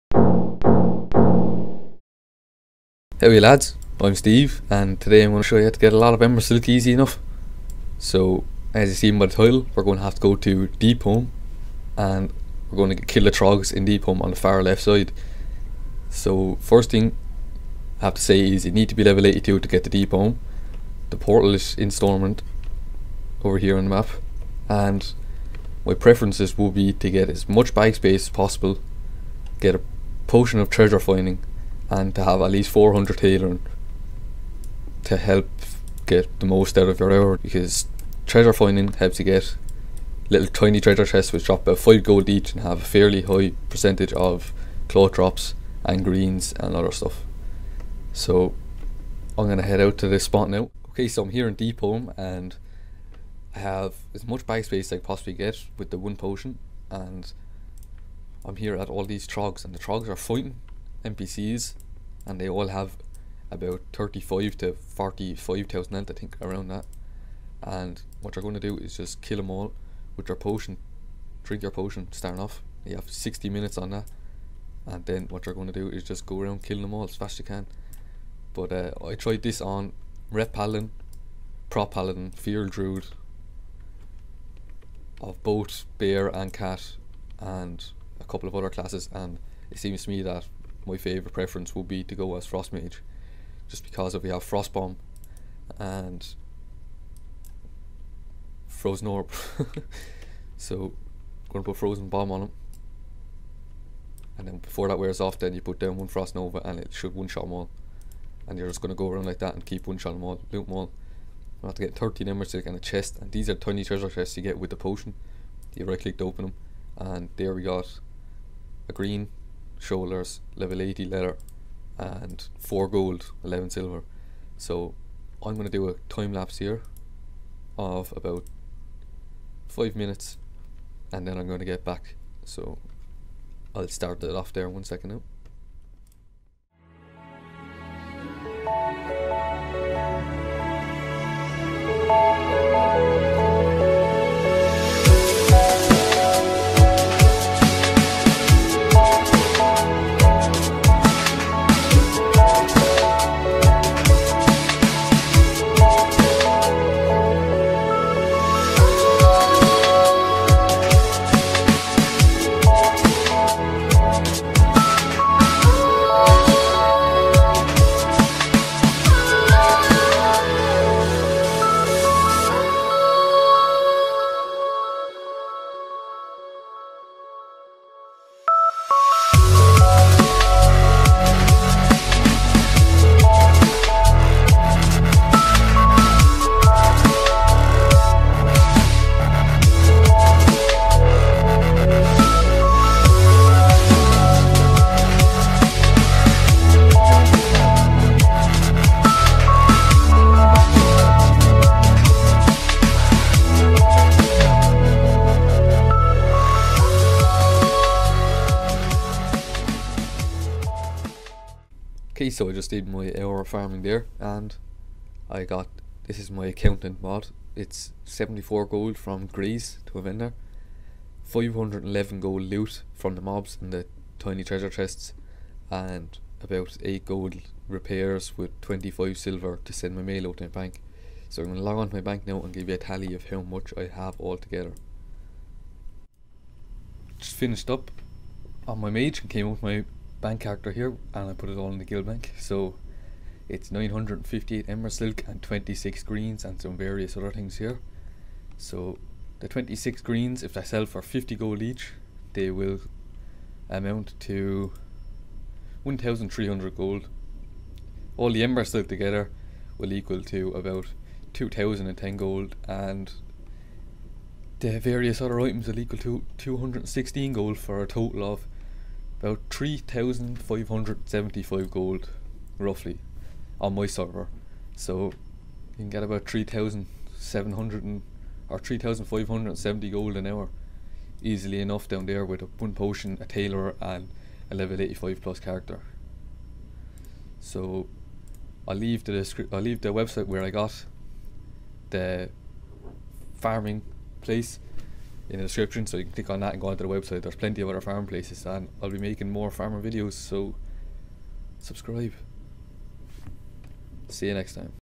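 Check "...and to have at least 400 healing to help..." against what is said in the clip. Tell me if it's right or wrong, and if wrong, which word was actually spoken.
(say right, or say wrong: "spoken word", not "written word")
right.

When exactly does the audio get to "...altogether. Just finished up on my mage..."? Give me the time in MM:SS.
03:54.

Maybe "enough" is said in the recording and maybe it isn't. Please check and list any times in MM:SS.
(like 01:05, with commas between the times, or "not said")
00:06, 04:41.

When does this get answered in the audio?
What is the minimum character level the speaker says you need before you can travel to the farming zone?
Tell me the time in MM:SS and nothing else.
00:19.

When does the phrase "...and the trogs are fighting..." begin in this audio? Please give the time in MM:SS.
00:59.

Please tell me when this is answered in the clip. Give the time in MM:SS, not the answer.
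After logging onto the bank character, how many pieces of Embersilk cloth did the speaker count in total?
04:03.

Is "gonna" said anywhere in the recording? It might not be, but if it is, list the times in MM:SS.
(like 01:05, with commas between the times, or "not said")
01:41, 01:48.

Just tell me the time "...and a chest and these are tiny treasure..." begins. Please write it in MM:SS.
01:52.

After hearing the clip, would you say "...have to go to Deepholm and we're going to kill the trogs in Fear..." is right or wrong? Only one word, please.
wrong.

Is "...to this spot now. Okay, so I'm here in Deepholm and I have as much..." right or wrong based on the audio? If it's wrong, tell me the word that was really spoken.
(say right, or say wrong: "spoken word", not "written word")
right.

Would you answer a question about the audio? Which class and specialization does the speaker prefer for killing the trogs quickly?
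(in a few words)
Frost mage.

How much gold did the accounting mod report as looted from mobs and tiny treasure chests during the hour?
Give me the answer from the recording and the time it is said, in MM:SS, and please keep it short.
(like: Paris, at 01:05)
511 gold, at 03:41.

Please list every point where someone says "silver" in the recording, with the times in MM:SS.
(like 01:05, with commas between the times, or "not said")
02:03, 03:49.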